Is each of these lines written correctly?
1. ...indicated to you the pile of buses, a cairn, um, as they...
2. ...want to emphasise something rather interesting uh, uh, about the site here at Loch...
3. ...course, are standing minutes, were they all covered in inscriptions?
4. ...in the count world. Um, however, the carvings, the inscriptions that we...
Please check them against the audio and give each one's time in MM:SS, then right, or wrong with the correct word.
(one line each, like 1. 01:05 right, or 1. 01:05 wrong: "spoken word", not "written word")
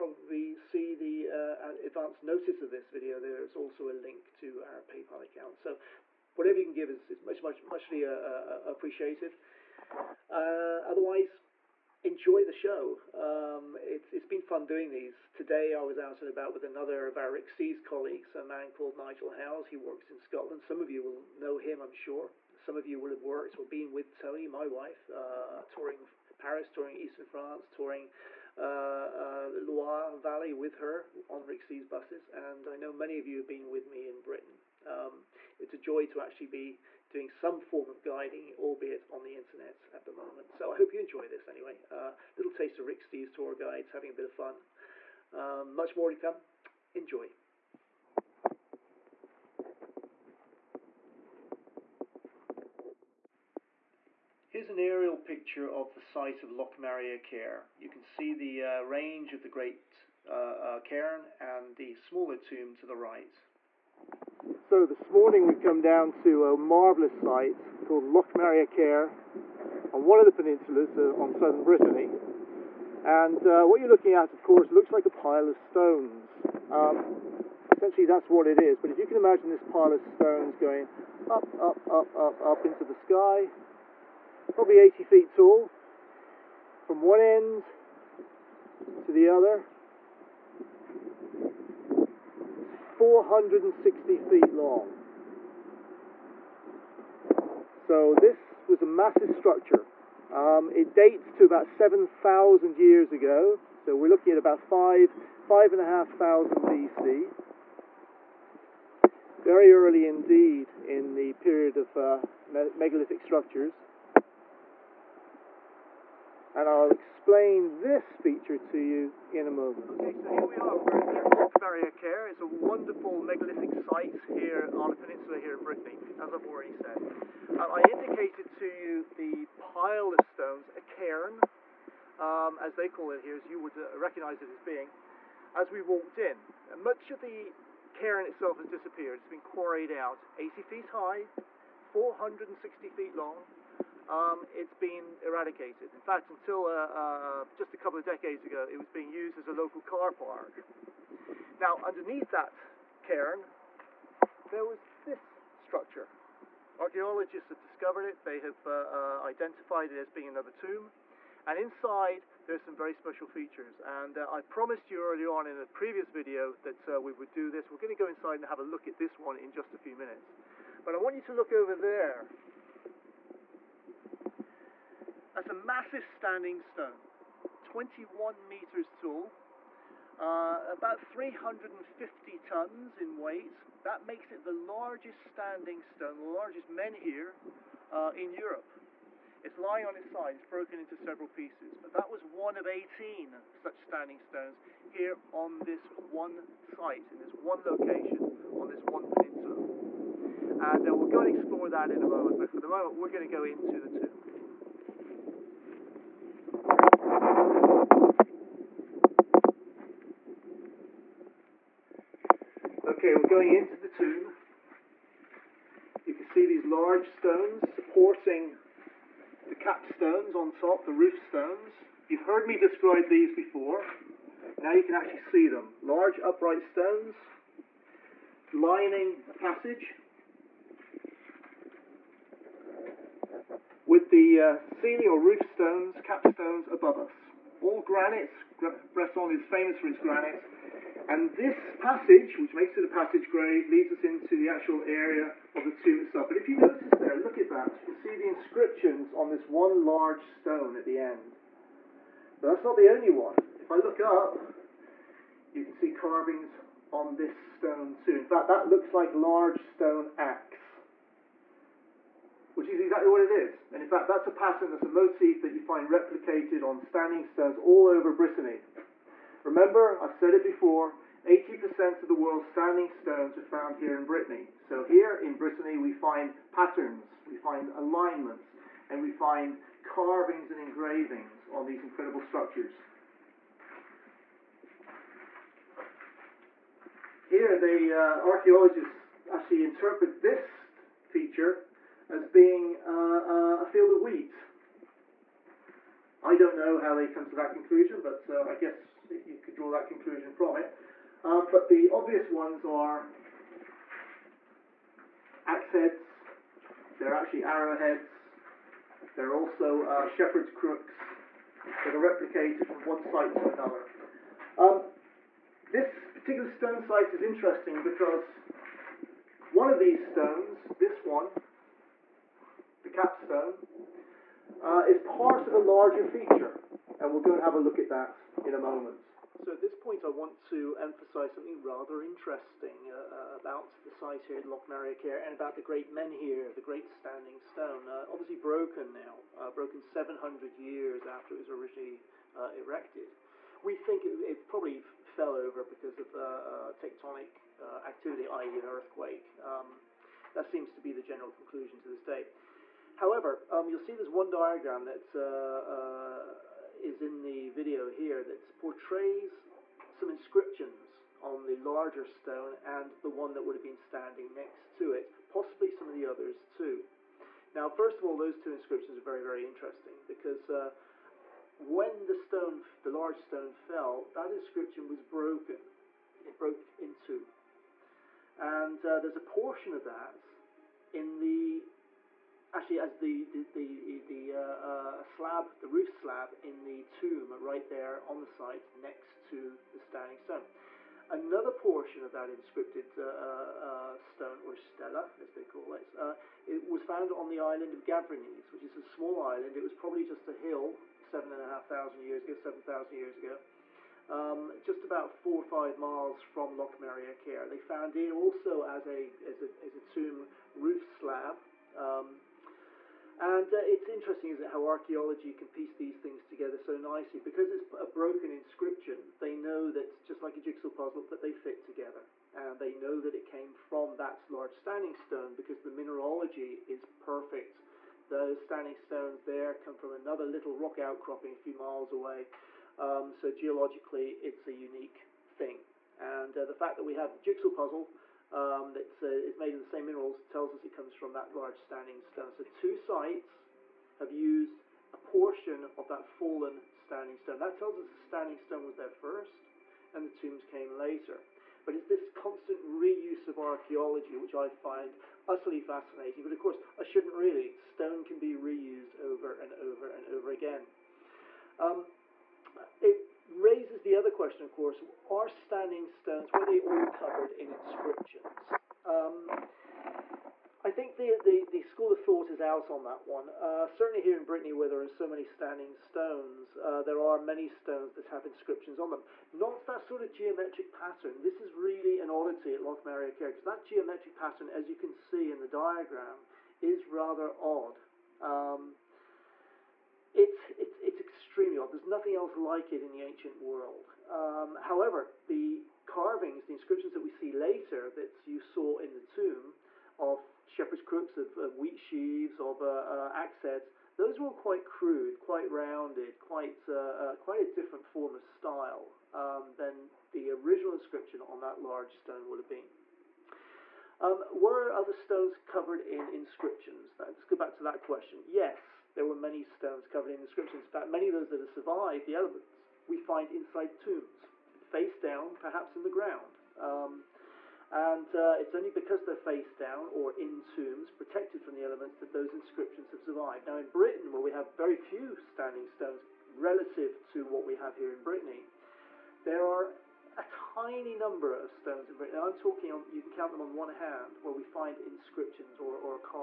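1. 02:07 wrong: "stones", not "buses"
2. 05:30 right
3. 07:44 wrong: "stones", not "minutes"
4. 08:12 wrong: "ancient", not "count".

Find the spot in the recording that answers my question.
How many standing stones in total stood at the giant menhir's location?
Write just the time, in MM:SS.
03:12.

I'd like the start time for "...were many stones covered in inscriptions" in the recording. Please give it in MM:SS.
08:39.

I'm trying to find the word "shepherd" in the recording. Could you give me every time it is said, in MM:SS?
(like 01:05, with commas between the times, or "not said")
05:10, 08:20.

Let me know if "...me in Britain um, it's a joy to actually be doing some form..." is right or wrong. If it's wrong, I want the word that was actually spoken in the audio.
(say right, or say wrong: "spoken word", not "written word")
right.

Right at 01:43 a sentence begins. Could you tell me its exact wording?
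So we're looking at about five, five and a half thousand BC.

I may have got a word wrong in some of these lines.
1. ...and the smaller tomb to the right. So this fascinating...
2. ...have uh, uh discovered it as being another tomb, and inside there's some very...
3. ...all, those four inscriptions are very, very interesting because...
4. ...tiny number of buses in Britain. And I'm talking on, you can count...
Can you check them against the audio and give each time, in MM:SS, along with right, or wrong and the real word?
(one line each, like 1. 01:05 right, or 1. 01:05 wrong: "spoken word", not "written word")
1. 01:01 wrong: "morning", not "fascinating"
2. 02:38 wrong: "identified", not "discovered"
3. 06:08 wrong: "two", not "four"
4. 09:00 wrong: "stones", not "buses".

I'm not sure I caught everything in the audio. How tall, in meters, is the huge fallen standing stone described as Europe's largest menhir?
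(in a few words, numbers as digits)
21 meters.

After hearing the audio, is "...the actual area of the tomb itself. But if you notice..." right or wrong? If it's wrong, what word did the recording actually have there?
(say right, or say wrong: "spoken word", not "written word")
right.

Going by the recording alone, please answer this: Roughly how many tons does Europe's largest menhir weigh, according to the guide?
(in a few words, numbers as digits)
350 tons.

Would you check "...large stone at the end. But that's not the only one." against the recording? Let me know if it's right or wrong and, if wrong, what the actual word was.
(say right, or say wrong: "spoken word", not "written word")
right.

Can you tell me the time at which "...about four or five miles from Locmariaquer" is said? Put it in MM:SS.
06:44.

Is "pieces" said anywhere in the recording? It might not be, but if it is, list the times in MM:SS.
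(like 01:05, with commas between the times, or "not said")
03:11, 06:55.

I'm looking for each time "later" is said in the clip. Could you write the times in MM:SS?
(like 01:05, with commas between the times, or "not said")
07:30, 08:17.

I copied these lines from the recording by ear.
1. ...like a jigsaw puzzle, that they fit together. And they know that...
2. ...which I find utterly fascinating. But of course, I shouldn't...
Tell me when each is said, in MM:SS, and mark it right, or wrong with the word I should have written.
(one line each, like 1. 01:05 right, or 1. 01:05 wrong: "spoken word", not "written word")
1. 07:00 right
2. 07:34 right.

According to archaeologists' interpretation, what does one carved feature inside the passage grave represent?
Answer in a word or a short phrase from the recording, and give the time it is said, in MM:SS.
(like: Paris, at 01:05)
a field of wheat, at 04:53.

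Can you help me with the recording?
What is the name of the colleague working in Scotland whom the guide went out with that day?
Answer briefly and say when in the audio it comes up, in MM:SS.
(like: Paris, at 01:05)
Nigel Howes, at 00:18.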